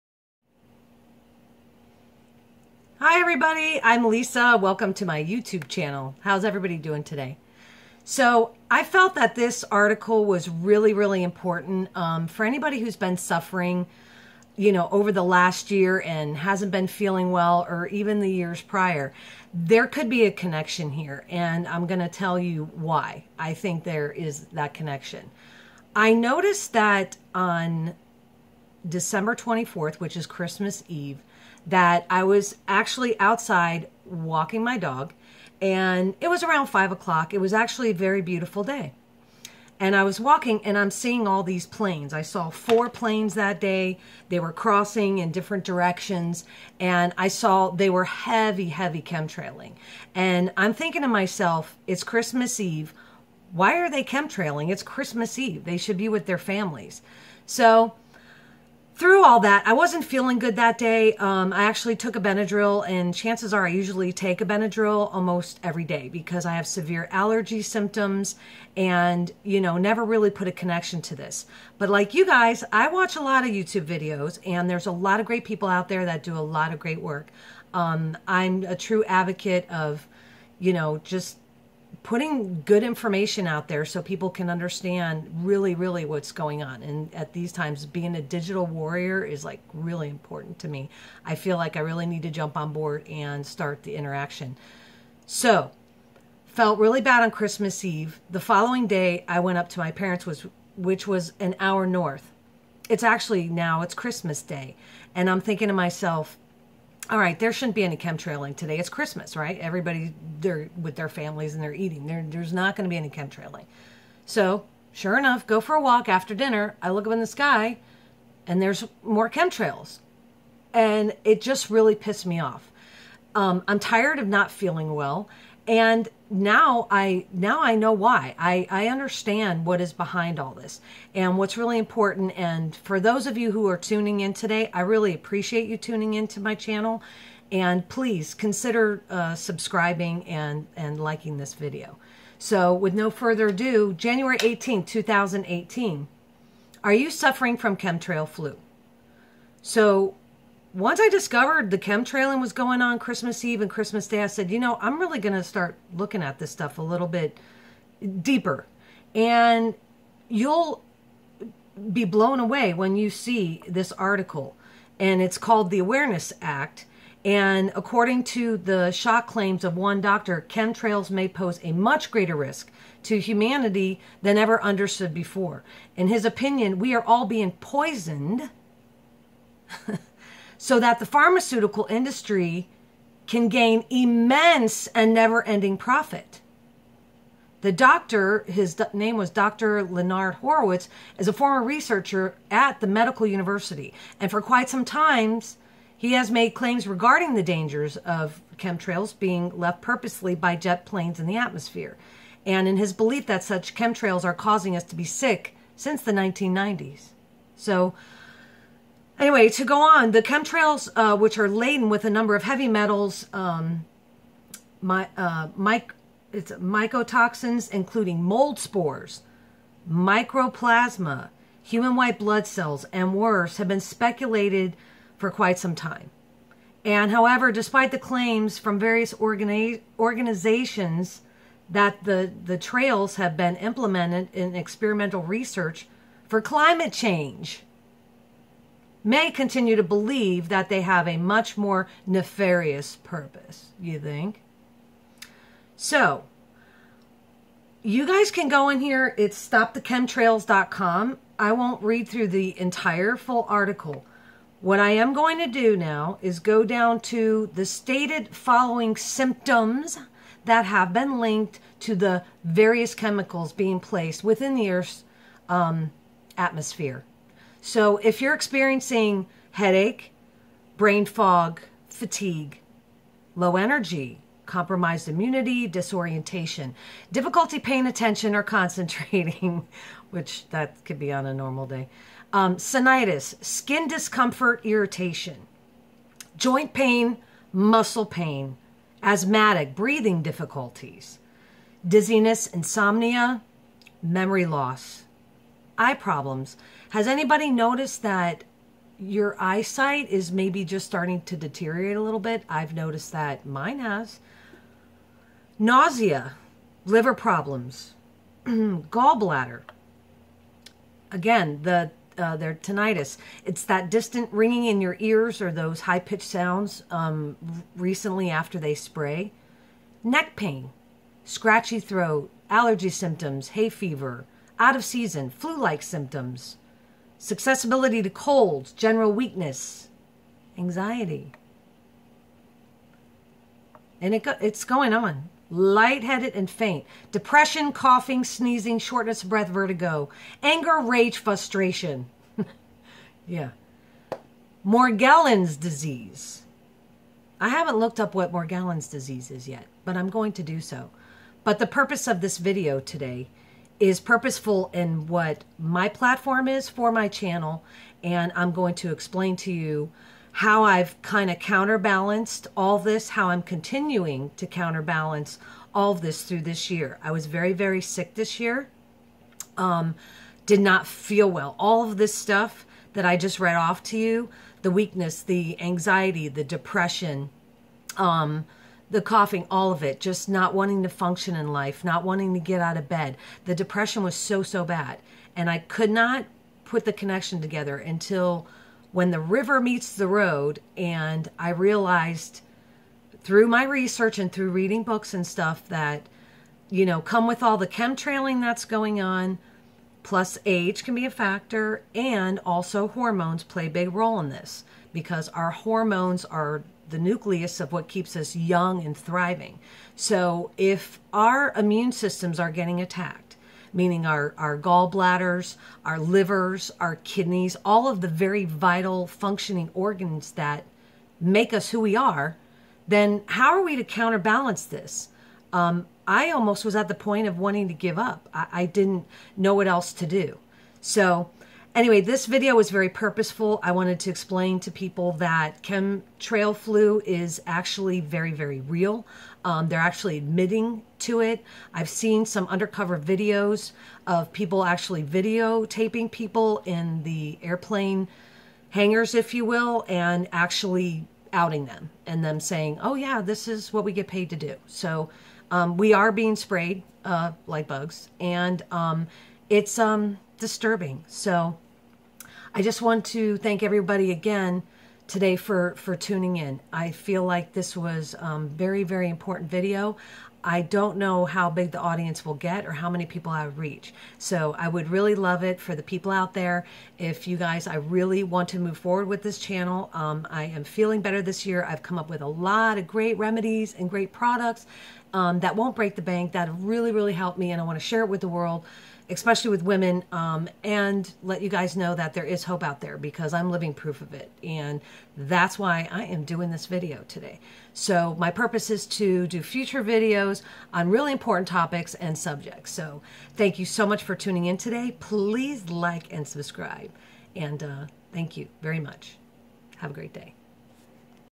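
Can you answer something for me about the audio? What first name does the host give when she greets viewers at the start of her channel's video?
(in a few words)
Lisa.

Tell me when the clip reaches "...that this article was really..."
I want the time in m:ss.
0:09.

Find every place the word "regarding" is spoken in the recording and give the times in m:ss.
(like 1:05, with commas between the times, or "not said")
3:16.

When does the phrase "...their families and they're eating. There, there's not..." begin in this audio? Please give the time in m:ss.
1:50.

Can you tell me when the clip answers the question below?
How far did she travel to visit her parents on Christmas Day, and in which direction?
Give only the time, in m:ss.
1:41.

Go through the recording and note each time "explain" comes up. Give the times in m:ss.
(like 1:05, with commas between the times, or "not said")
5:58, 7:14.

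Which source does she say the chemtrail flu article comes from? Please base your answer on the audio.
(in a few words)
The Awareness Act.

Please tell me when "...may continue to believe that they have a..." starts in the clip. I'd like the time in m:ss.
3:59.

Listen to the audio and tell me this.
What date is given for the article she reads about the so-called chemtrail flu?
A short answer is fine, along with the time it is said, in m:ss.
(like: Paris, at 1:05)
January 18, 2018, at 2:23.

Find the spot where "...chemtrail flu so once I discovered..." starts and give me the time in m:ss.
2:27.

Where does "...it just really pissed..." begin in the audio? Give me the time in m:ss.
2:01.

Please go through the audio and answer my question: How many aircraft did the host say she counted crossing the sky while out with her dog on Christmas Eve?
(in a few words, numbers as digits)
4.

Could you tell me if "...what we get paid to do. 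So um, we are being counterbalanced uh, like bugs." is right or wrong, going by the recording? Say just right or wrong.
wrong.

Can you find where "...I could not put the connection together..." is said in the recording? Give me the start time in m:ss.
6:25.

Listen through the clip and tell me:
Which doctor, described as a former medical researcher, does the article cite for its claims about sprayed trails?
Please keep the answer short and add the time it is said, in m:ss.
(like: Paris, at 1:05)
Dr. Leonard Horowitz, at 3:09.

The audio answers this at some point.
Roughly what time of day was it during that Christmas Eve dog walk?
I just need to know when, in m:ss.
0:36.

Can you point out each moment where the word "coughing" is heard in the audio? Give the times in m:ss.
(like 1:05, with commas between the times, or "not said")
5:37, 6:19.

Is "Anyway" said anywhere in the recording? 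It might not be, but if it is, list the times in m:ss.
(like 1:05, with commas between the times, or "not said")
3:29, 7:11.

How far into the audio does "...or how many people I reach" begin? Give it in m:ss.
7:52.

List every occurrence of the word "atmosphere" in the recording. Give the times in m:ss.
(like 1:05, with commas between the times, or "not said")
3:21, 4:26.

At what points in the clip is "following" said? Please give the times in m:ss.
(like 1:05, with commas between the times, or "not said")
1:38, 4:18.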